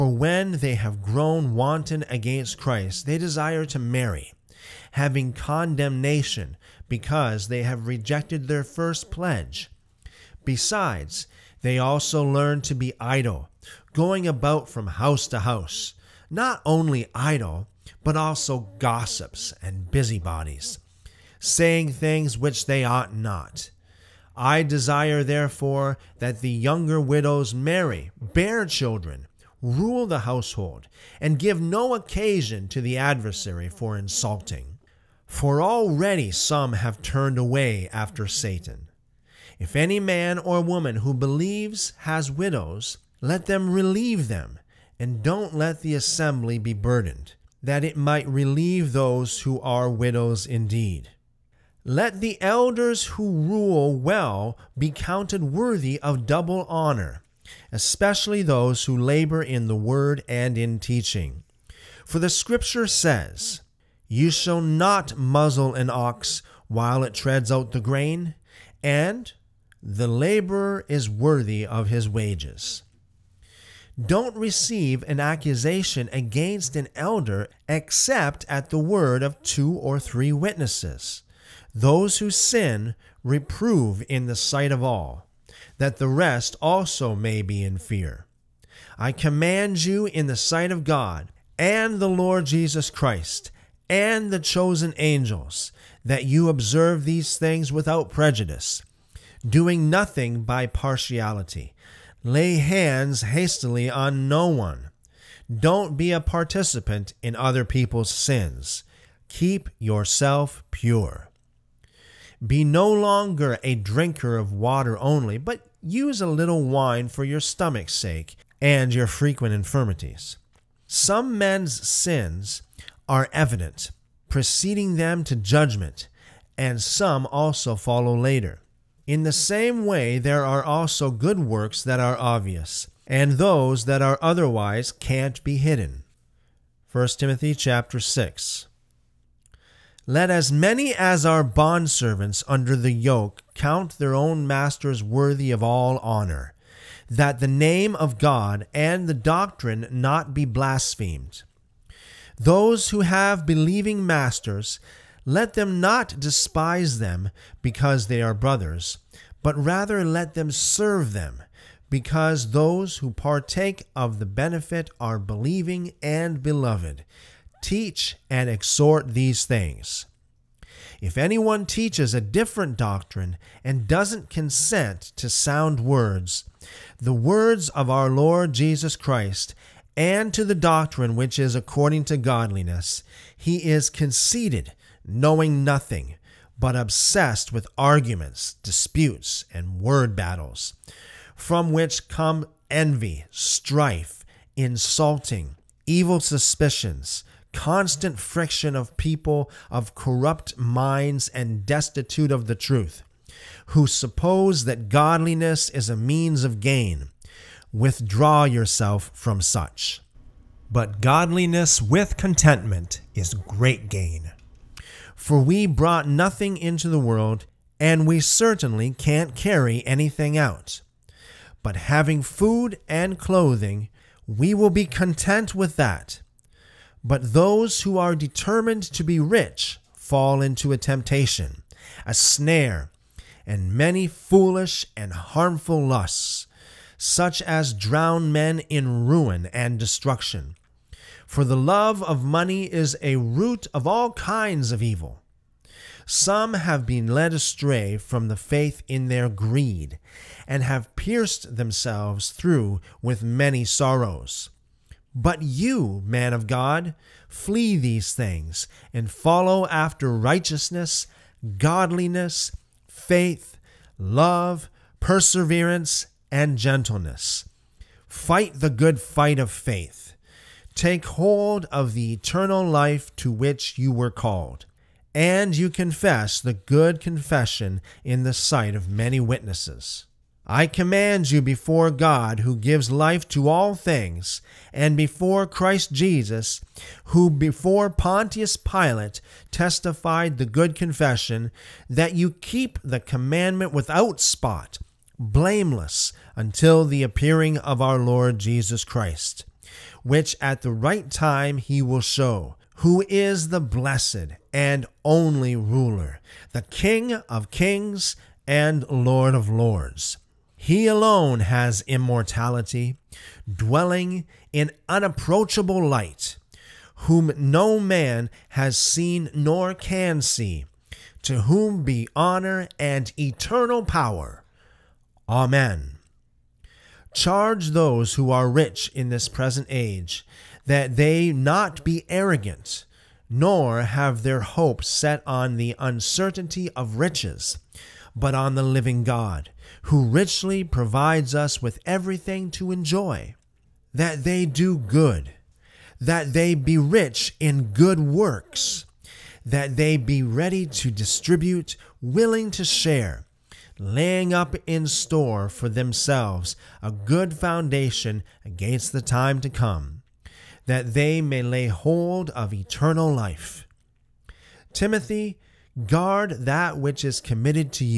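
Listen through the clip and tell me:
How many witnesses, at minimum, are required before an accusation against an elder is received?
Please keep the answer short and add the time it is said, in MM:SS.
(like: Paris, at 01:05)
2 or 3, at 01:19.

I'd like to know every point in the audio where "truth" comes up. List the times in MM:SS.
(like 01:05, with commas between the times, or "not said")
03:22.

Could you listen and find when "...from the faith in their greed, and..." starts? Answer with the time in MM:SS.
04:07.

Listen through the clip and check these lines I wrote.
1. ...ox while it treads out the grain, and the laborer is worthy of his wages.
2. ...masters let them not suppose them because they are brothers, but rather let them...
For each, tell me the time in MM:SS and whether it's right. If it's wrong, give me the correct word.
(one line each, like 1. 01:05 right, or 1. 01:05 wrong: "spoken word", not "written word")
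1. 01:05 right
2. 02:34 wrong: "despise", not "suppose".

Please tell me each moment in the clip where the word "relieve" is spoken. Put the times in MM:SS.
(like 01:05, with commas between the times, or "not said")
00:43, 00:48.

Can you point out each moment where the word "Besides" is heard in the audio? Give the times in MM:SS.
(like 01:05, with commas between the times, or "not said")
00:10.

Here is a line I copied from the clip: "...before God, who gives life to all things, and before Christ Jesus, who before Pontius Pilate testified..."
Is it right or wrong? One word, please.
right.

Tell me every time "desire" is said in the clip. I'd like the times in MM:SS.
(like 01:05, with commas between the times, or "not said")
00:03, 00:24.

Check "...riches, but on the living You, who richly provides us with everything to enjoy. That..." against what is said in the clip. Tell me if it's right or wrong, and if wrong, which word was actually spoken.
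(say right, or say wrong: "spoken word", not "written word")
wrong: "God", not "You".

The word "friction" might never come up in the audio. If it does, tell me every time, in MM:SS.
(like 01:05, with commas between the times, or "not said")
03:18.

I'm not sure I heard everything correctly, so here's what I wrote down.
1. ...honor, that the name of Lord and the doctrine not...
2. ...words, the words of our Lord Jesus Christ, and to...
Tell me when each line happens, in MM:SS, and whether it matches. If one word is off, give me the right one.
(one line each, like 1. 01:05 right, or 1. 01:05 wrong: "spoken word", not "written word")
1. 02:25 wrong: "God", not "Lord"
2. 02:55 right.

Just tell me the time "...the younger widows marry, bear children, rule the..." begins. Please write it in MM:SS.
00:26.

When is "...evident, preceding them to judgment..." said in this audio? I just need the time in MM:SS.
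02:03.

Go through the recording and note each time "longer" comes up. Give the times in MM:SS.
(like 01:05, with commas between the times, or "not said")
01:52.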